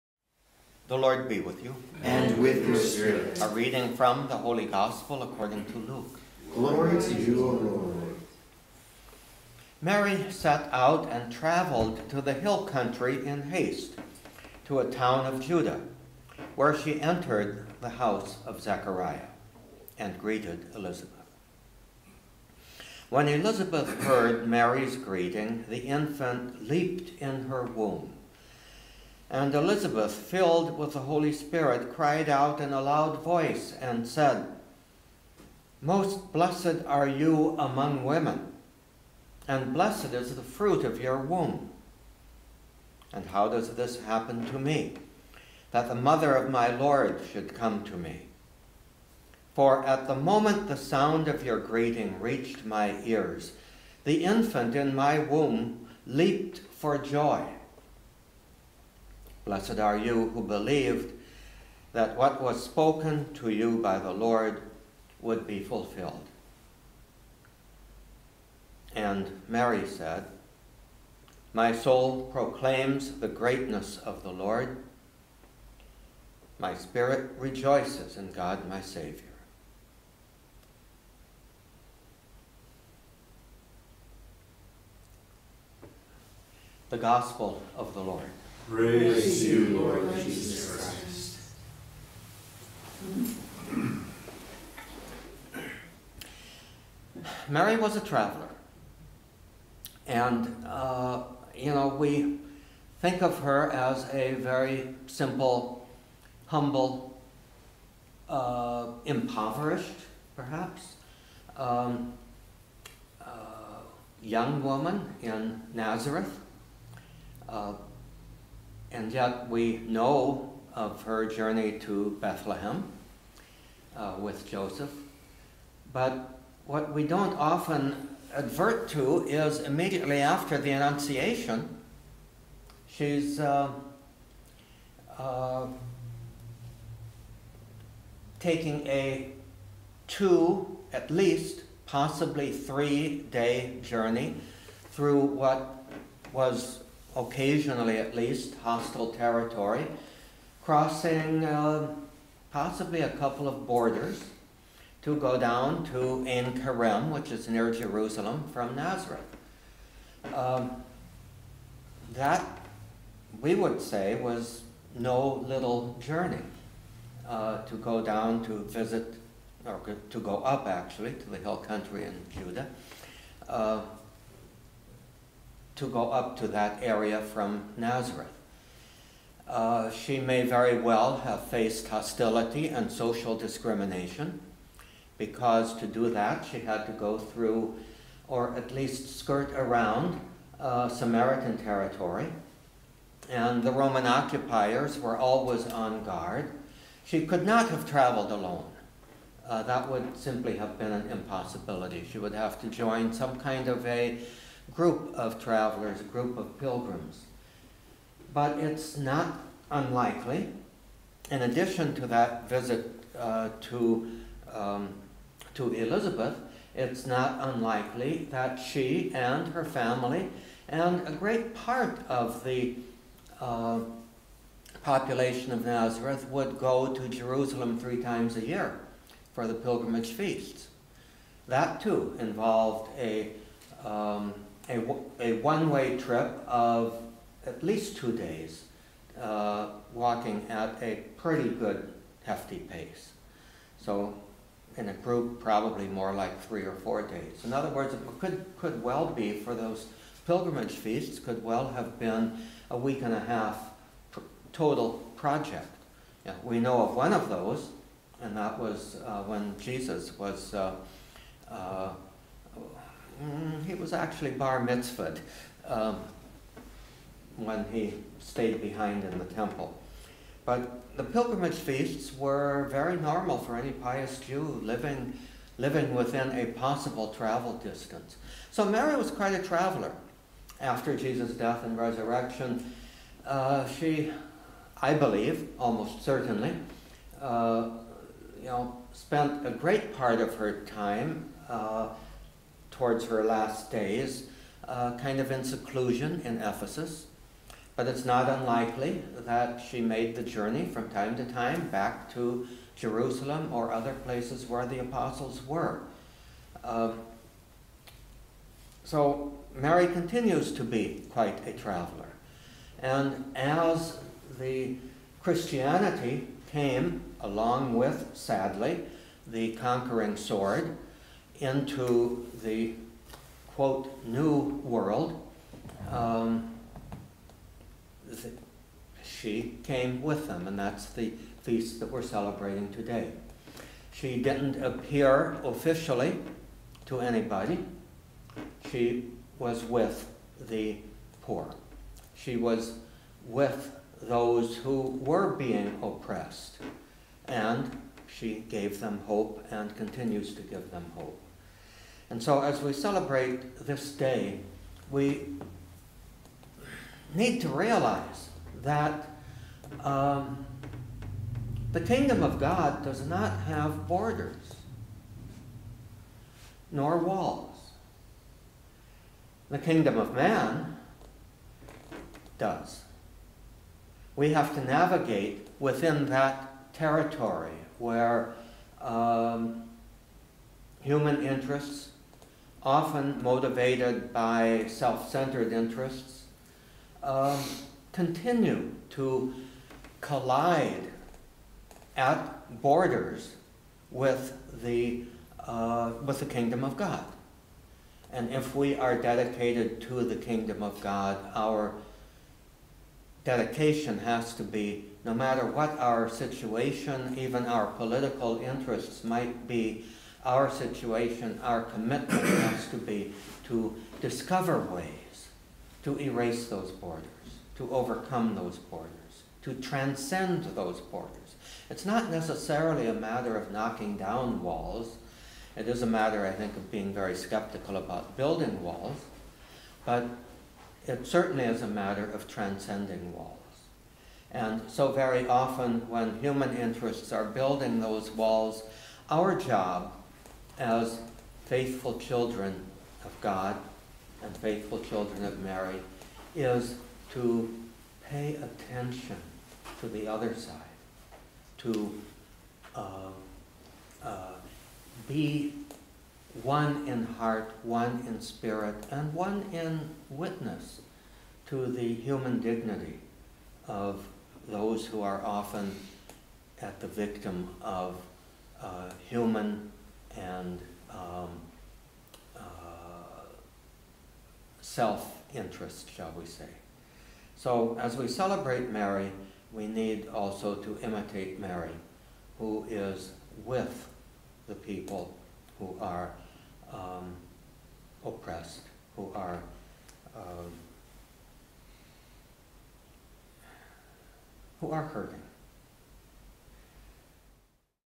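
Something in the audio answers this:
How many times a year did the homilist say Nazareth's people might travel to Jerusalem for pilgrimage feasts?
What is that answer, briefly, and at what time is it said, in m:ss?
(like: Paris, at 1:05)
3, at 3:47.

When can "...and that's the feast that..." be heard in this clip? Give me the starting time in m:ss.
5:30.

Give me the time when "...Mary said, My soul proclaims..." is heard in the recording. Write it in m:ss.
1:09.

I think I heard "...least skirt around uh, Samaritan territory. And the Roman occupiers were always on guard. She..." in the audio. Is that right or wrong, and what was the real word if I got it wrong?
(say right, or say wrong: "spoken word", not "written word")
right.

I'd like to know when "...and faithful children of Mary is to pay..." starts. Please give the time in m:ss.
7:24.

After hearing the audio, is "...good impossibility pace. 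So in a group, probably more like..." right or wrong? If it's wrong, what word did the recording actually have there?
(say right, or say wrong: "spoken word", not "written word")
wrong: "hefty", not "impossibility".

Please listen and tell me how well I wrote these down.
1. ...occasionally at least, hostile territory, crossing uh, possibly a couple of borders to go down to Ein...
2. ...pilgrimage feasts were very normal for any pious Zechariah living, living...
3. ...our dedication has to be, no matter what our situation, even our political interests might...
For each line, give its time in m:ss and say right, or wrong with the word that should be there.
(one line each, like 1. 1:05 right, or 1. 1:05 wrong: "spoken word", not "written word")
1. 2:27 right
2. 4:31 wrong: "Jew", not "Zechariah"
3. 6:41 right.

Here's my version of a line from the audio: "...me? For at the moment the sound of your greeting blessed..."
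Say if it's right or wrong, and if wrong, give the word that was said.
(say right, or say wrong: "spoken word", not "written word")
wrong: "reached", not "blessed".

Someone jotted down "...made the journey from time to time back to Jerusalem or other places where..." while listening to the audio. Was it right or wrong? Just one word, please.
right.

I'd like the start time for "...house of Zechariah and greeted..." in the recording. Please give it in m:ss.
0:17.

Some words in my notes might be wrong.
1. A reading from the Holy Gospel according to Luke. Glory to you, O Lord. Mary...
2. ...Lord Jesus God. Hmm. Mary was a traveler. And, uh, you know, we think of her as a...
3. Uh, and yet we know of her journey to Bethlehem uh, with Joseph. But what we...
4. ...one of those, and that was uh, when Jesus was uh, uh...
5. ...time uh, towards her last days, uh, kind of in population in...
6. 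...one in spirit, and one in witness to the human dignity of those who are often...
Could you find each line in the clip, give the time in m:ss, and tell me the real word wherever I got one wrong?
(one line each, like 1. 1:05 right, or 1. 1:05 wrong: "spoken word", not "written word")
1. 0:03 right
2. 1:29 wrong: "Christ", not "God"
3. 1:57 right
4. 4:16 right
5. 4:50 wrong: "seclusion", not "population"
6. 7:37 right.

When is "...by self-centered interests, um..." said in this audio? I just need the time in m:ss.
6:24.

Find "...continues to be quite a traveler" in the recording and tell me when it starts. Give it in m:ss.
5:09.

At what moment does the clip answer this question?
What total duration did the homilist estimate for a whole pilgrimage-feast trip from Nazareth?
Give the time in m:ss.
4:12.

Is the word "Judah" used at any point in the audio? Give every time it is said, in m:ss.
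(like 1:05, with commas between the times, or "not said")
0:15, 2:52.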